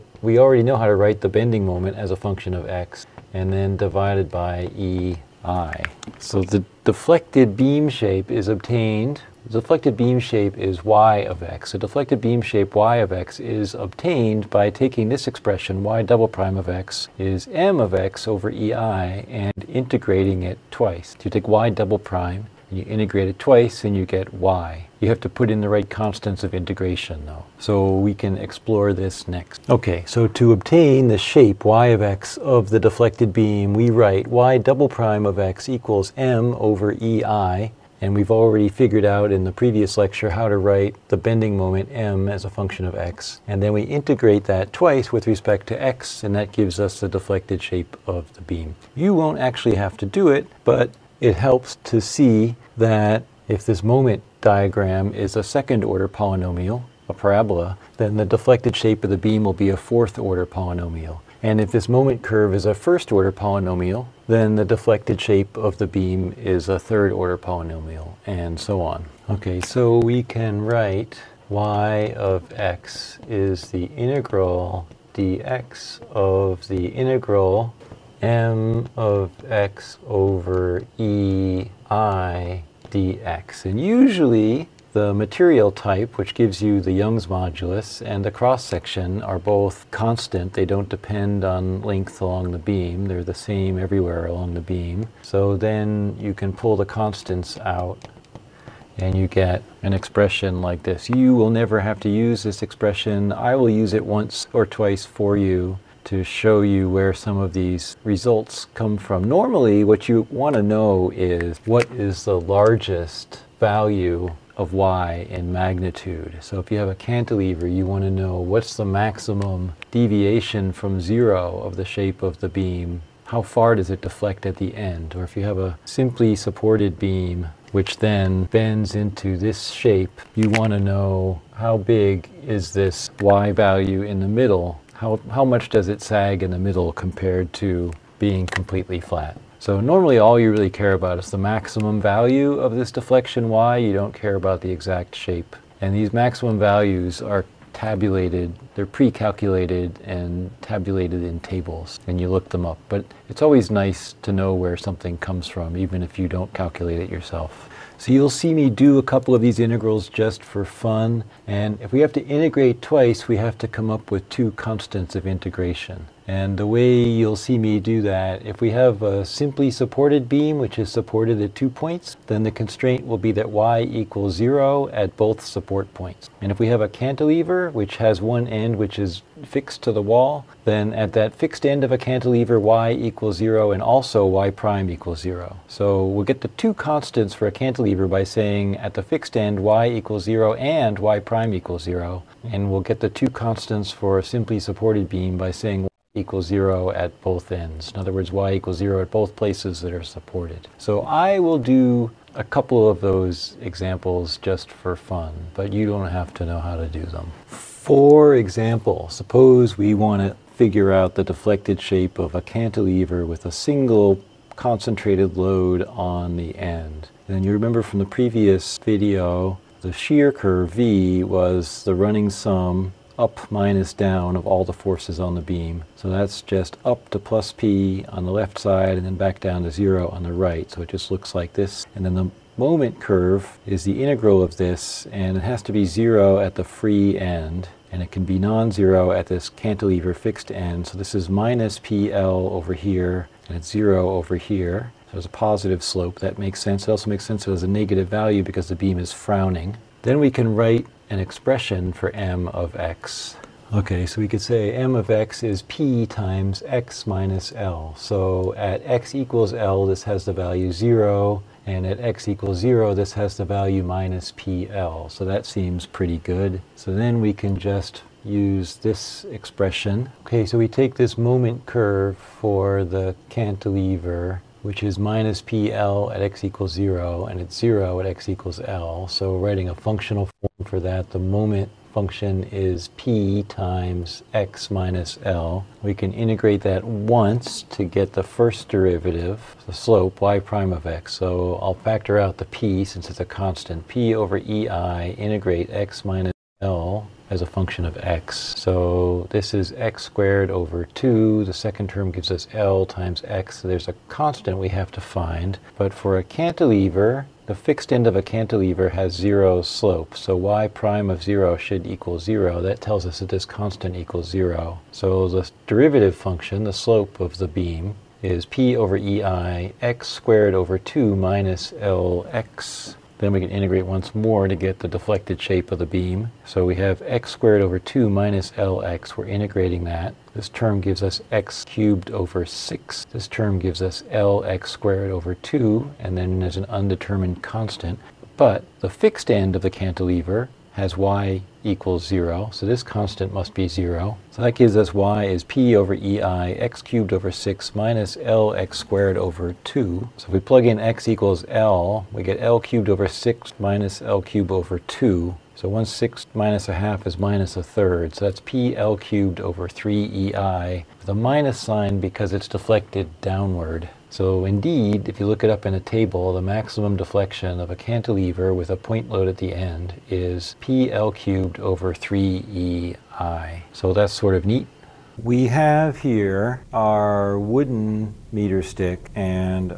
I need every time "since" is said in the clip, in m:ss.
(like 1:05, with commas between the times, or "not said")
4:52.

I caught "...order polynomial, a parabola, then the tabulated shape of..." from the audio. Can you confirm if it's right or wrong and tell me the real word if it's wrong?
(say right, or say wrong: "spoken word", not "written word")
wrong: "deflected", not "tabulated".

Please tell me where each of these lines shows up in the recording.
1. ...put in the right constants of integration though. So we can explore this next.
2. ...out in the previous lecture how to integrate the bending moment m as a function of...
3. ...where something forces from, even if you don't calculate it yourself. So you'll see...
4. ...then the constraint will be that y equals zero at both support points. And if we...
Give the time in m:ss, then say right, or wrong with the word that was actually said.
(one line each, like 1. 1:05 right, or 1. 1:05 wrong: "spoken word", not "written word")
1. 0:25 right
2. 0:39 wrong: "write", not "integrate"
3. 2:34 wrong: "comes", not "forces"
4. 2:52 right.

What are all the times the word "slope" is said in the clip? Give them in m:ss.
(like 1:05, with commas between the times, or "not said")
4:05, 4:49, 5:09, 5:16.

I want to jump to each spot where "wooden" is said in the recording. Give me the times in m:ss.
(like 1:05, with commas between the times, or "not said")
6:17.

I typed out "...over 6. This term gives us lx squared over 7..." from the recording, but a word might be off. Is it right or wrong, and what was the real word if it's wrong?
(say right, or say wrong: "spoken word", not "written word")
wrong: "2", not "7".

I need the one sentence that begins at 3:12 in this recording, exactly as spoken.
And we'll get the two constants for a simply supported beam by saying equals zero at both ends.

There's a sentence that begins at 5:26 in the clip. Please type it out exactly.
So we have x squared over 2 minus lx.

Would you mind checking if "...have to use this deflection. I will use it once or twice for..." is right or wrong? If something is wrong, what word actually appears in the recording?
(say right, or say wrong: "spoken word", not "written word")
wrong: "expression", not "deflection".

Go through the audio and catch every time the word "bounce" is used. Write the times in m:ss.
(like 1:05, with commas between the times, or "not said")
not said.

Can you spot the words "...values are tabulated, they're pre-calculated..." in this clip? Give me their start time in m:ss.
2:26.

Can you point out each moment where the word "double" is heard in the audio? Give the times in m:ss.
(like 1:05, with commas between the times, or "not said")
0:16, 0:21, 0:34.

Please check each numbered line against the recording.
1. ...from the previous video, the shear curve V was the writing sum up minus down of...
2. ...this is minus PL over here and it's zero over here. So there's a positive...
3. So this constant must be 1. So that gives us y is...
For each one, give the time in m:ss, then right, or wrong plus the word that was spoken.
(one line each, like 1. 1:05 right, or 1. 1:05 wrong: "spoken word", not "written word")
1. 3:37 wrong: "running", not "writing"
2. 4:00 right
3. 5:42 wrong: "0", not "1".